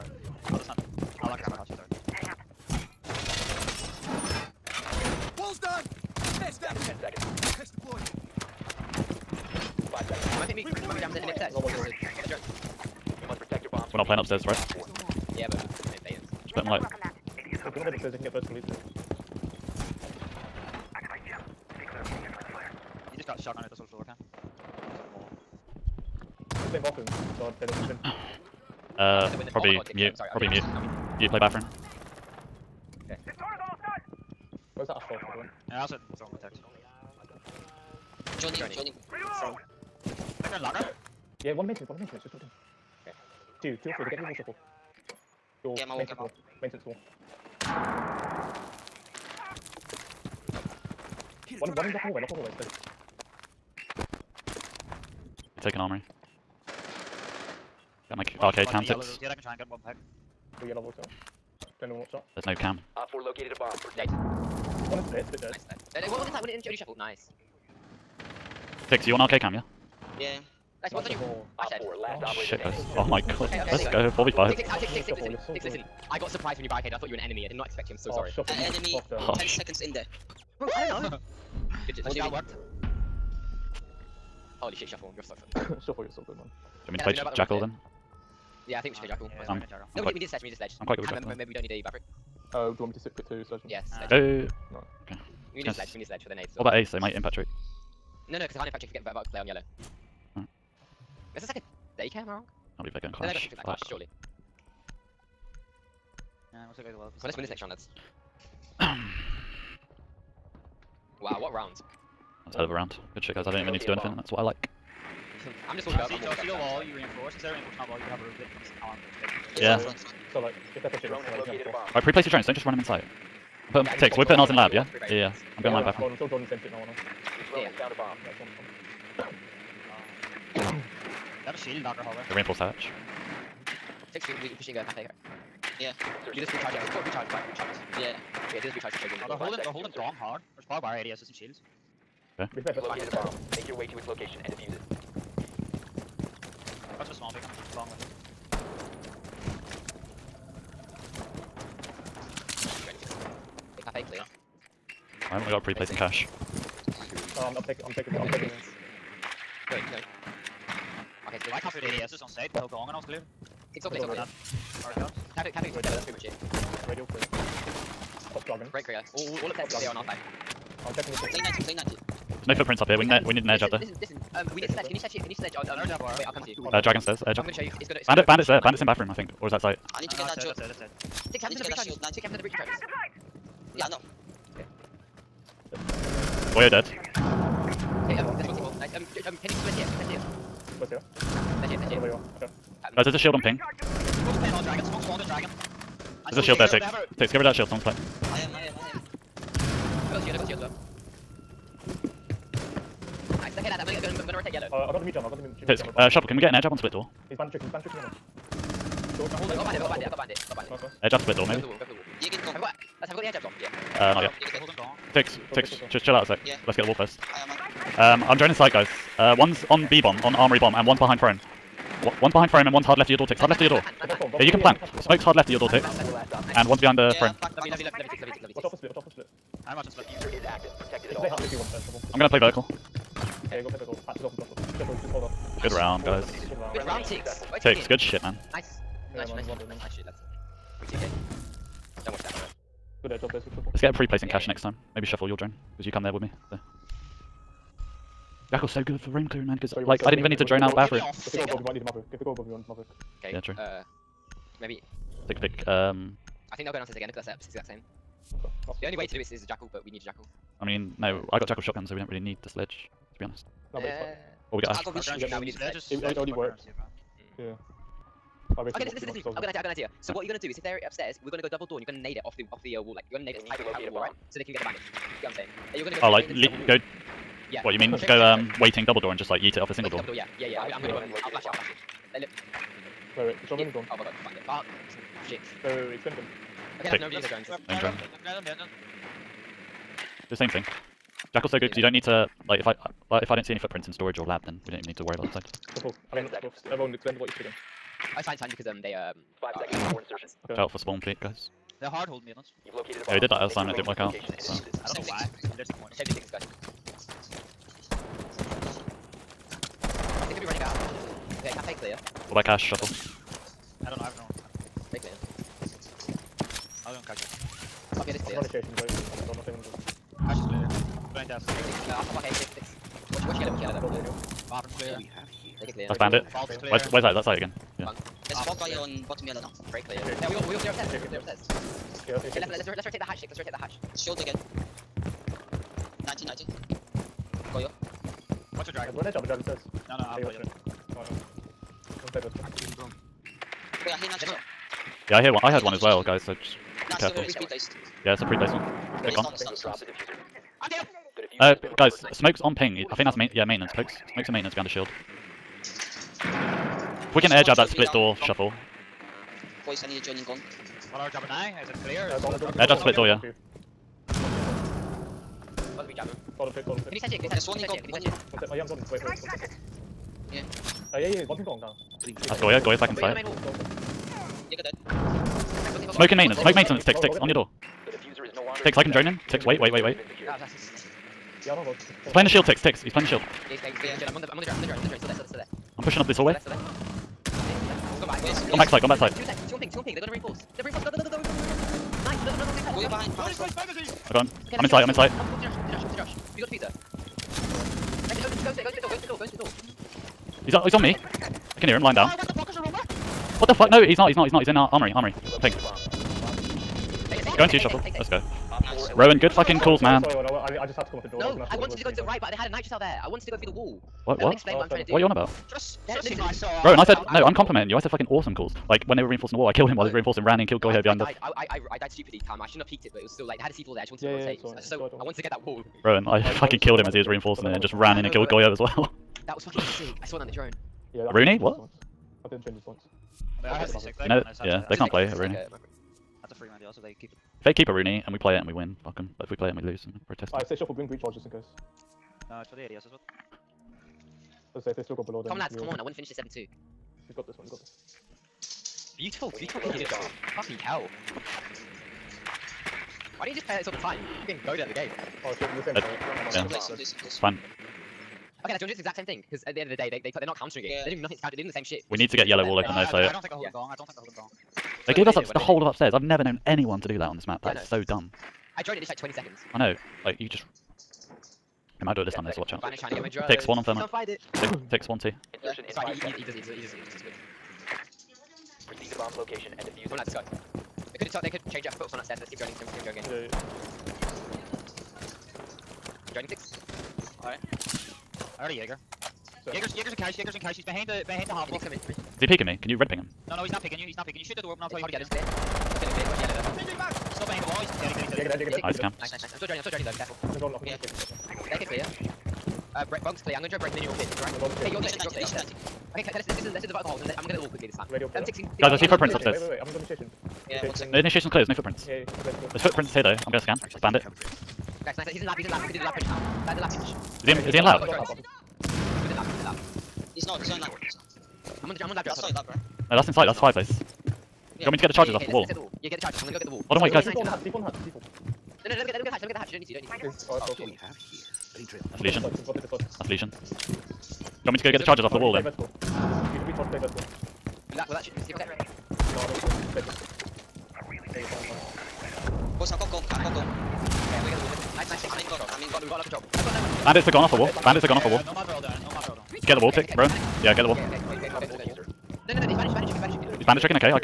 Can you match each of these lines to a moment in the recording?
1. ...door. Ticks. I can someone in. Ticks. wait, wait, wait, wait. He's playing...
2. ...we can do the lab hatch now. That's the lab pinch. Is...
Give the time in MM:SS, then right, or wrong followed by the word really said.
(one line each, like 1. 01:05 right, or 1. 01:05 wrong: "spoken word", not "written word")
1. 06:17 wrong: "drone", not "someone"
2. 08:35 wrong: "pinch", not "hatch".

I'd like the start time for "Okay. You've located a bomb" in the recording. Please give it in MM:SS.
02:22.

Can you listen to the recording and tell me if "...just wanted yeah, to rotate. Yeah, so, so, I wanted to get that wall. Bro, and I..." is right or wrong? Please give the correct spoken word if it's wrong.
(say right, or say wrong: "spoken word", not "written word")
right.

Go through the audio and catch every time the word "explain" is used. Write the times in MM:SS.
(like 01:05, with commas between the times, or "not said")
04:56, 06:54.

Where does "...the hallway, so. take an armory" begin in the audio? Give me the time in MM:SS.
00:52.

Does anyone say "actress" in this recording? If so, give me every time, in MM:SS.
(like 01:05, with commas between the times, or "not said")
not said.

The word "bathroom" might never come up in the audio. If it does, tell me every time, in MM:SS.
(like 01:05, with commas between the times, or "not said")
00:26, 00:31, 02:05, 02:58, 04:10.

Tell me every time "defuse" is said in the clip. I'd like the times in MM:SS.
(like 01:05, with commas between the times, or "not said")
02:24, 07:59.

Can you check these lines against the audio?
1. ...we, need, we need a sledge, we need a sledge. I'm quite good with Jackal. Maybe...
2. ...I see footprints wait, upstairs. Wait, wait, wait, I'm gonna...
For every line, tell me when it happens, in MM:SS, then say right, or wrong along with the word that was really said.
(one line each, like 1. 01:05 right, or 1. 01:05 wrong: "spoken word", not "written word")
1. 01:30 right
2. 08:28 right.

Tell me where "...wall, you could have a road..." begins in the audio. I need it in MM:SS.
01:57.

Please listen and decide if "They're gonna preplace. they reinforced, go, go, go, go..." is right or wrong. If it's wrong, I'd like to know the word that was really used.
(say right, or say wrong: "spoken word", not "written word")
wrong: "reinforce", not "preplace".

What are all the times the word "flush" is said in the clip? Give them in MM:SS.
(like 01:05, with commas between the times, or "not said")
03:54.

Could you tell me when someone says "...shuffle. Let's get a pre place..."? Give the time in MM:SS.
04:03.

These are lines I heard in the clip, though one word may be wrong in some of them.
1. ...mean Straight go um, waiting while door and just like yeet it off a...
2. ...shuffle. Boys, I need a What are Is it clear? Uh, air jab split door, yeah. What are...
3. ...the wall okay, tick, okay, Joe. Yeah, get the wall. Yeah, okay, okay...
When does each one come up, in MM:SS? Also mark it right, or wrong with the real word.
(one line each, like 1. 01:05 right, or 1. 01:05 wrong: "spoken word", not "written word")
1. 04:37 wrong: "double", not "while"
2. 05:58 right
3. 09:09 wrong: "Rowan", not "Joe".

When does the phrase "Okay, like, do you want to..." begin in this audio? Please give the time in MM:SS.
07:38.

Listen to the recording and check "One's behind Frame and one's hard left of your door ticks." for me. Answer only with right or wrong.
right.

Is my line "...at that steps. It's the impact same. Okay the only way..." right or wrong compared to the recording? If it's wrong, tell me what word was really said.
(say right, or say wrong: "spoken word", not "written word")
wrong: "exact", not "impact".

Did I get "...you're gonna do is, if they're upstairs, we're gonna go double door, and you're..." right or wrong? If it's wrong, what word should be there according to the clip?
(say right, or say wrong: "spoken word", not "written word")
right.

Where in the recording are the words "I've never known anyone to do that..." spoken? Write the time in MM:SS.
07:45.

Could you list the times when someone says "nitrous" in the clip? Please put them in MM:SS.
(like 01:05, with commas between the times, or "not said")
06:52.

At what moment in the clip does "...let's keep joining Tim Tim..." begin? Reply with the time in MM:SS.
08:02.